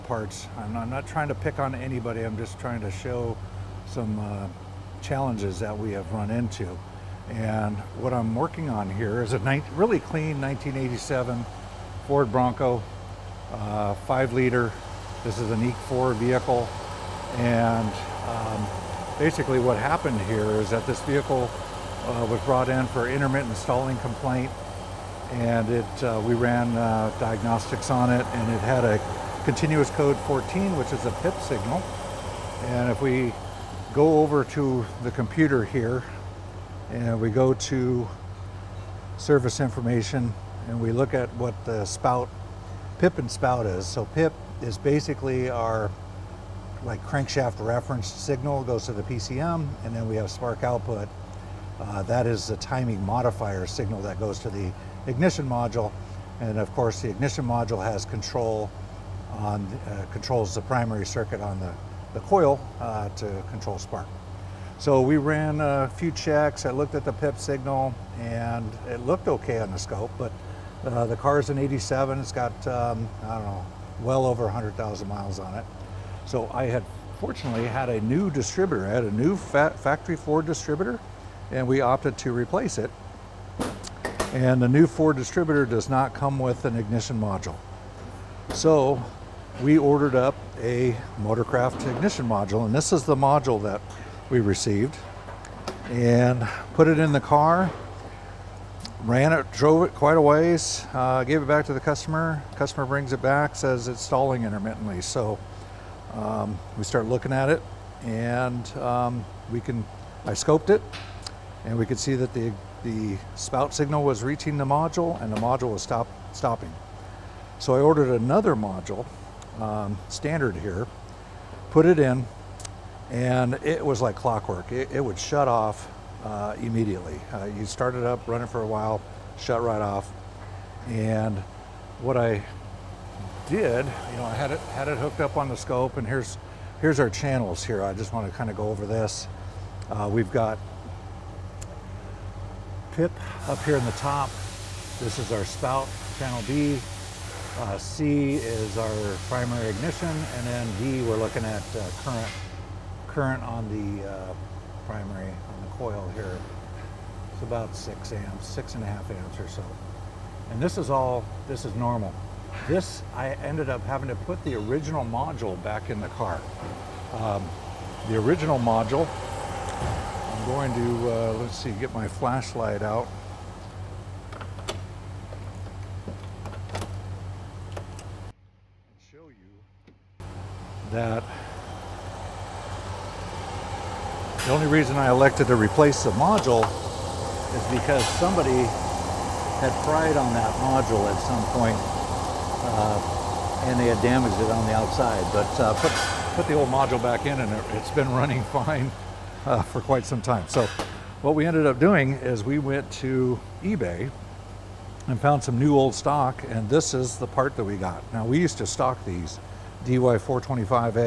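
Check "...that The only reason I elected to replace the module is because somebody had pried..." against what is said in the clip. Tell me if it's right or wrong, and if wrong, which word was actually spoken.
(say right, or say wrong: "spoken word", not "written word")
right.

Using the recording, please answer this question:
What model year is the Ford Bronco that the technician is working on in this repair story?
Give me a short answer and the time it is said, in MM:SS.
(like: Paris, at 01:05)
1987, at 00:10.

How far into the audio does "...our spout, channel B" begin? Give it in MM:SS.
02:25.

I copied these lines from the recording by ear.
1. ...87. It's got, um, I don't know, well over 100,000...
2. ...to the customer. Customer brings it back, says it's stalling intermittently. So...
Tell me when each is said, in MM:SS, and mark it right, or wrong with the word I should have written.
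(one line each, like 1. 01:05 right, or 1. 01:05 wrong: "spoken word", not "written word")
1. 01:11 right
2. 01:41 right.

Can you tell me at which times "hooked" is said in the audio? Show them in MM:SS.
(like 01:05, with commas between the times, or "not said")
02:14.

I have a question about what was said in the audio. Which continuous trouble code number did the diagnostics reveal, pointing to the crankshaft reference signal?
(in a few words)
14.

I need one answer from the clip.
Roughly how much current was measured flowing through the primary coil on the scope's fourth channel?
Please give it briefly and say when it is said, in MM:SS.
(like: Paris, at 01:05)
6.5 amps, at 02:38.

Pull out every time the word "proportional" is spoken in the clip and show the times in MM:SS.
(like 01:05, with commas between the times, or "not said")
not said.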